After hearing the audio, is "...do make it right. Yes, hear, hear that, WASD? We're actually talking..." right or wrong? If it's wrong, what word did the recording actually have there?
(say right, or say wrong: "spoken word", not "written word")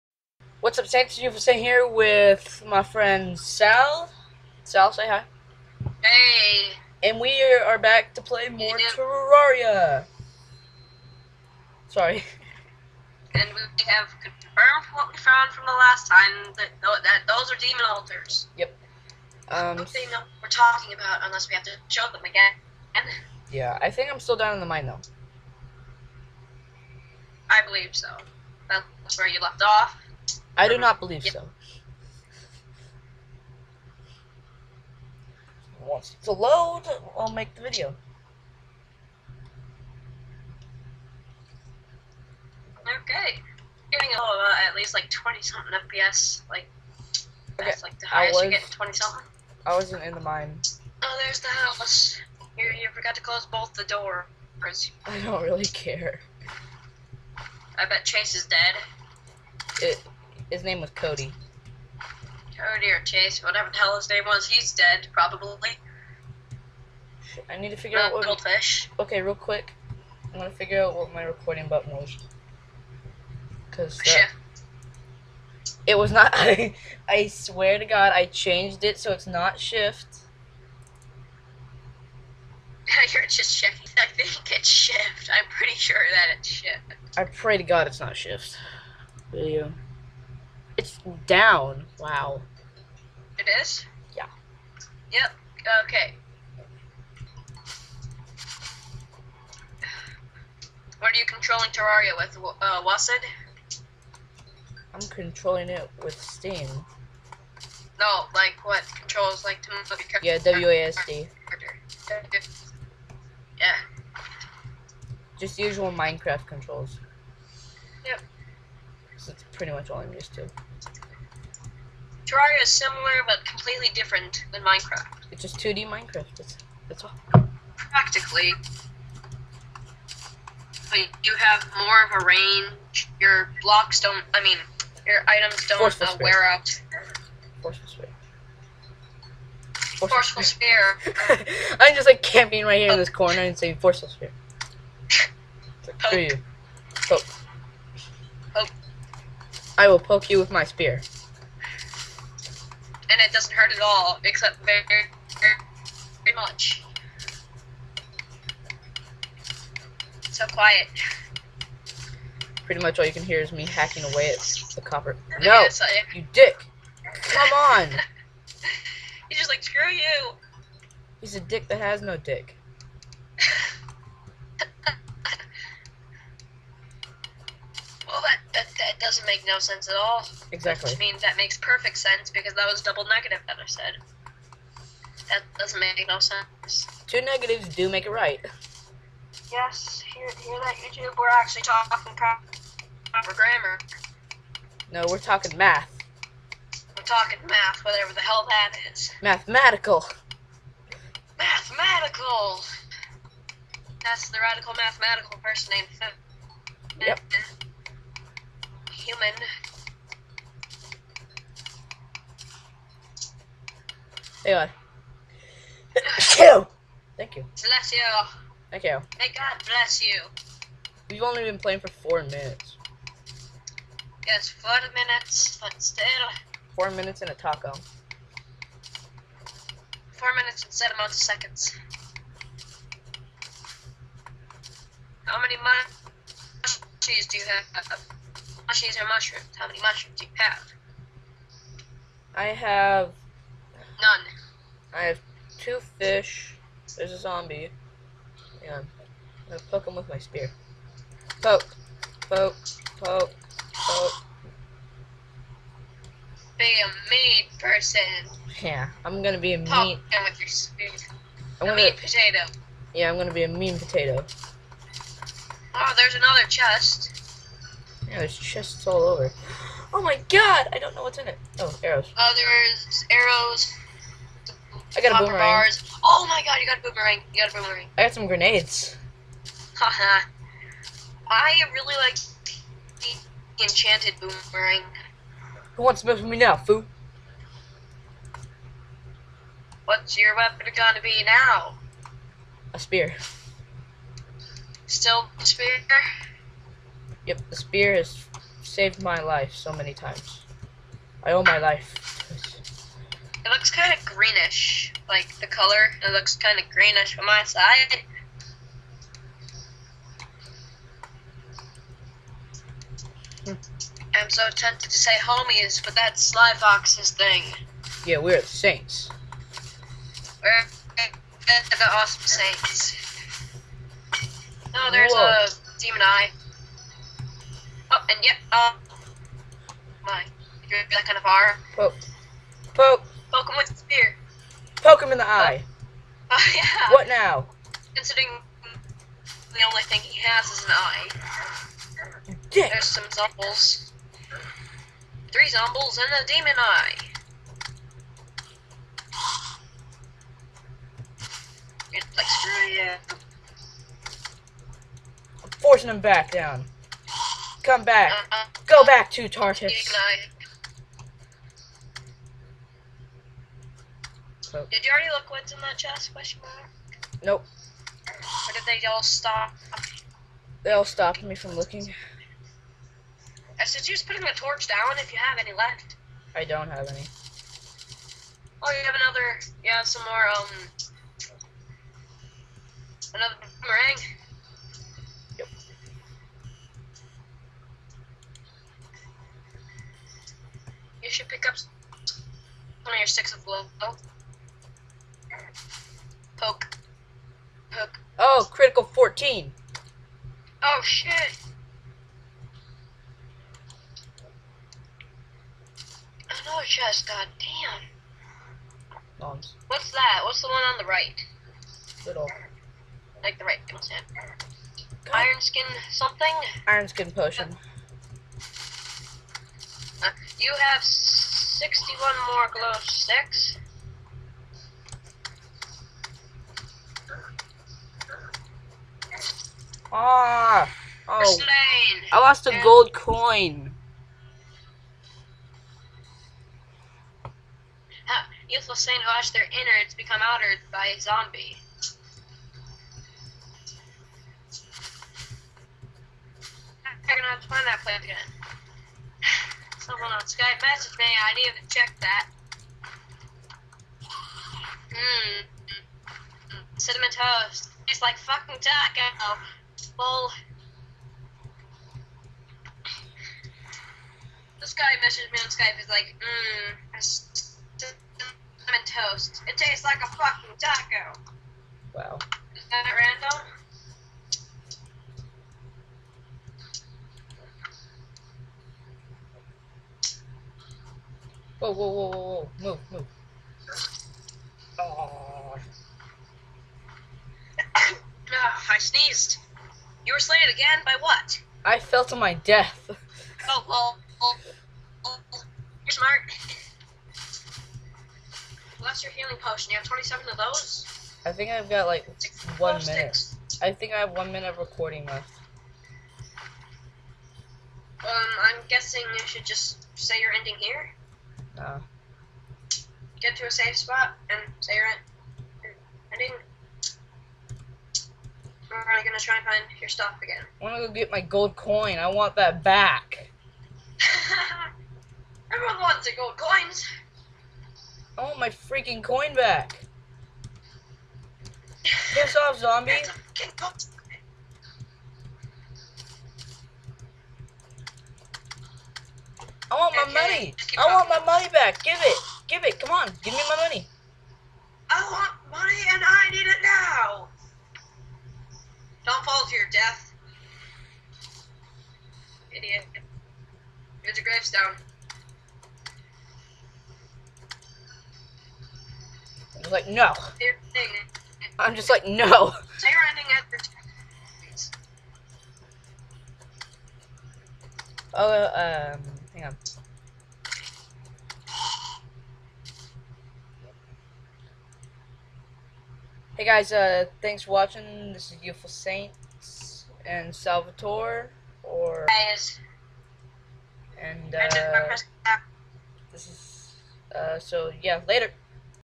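wrong: "YouTube", not "WASD".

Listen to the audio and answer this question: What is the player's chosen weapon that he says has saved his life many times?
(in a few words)
A spear.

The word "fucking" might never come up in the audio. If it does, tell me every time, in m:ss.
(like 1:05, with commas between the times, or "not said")
7:38, 7:50.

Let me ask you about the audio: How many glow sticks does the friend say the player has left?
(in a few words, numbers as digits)
61.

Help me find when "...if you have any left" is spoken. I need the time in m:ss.
6:14.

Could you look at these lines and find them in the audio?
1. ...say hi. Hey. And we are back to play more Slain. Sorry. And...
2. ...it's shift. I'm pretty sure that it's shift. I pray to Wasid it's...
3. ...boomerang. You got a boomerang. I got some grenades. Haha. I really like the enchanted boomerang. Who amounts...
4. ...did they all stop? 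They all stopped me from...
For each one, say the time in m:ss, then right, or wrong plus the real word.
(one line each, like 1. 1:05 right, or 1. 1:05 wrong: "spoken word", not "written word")
1. 0:04 wrong: "Terraria", not "Slain"
2. 1:24 wrong: "God", not "Wasid"
3. 4:36 wrong: "wants", not "amounts"
4. 6:08 right.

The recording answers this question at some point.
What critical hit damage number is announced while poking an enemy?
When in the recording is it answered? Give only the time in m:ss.
6:38.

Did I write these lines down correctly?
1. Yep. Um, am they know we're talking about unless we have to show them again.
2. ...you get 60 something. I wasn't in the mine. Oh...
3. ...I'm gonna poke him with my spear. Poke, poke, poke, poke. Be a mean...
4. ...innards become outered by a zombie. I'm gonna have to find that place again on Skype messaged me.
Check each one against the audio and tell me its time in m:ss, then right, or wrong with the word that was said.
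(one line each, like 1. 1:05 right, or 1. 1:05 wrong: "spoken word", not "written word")
1. 0:18 right
2. 0:48 wrong: "20", not "60"
3. 4:08 right
4. 7:19 right.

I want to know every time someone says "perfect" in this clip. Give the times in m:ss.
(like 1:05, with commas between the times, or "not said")
3:01.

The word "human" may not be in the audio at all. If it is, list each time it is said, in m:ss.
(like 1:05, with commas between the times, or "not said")
3:29.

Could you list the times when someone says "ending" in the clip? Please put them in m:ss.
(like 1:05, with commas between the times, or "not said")
8:30, 9:23.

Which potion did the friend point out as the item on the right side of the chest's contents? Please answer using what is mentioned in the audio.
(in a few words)
Iron skin potion.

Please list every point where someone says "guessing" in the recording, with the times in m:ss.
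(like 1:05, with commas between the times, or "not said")
8:28.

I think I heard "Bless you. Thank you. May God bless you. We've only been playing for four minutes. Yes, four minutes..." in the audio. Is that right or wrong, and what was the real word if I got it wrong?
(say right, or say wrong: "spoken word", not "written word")
right.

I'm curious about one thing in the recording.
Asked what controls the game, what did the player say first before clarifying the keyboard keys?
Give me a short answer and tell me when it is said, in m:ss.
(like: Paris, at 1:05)
Steam, at 1:46.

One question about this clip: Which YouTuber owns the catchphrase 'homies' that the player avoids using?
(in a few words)
Slyfox.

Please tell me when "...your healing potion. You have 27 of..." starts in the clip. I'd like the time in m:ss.
8:19.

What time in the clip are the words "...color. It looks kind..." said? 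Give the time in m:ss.
5:05.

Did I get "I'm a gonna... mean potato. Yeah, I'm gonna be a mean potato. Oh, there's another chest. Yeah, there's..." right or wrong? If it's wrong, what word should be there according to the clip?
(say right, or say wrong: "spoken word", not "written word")
right.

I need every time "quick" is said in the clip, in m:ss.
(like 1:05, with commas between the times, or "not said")
1:09.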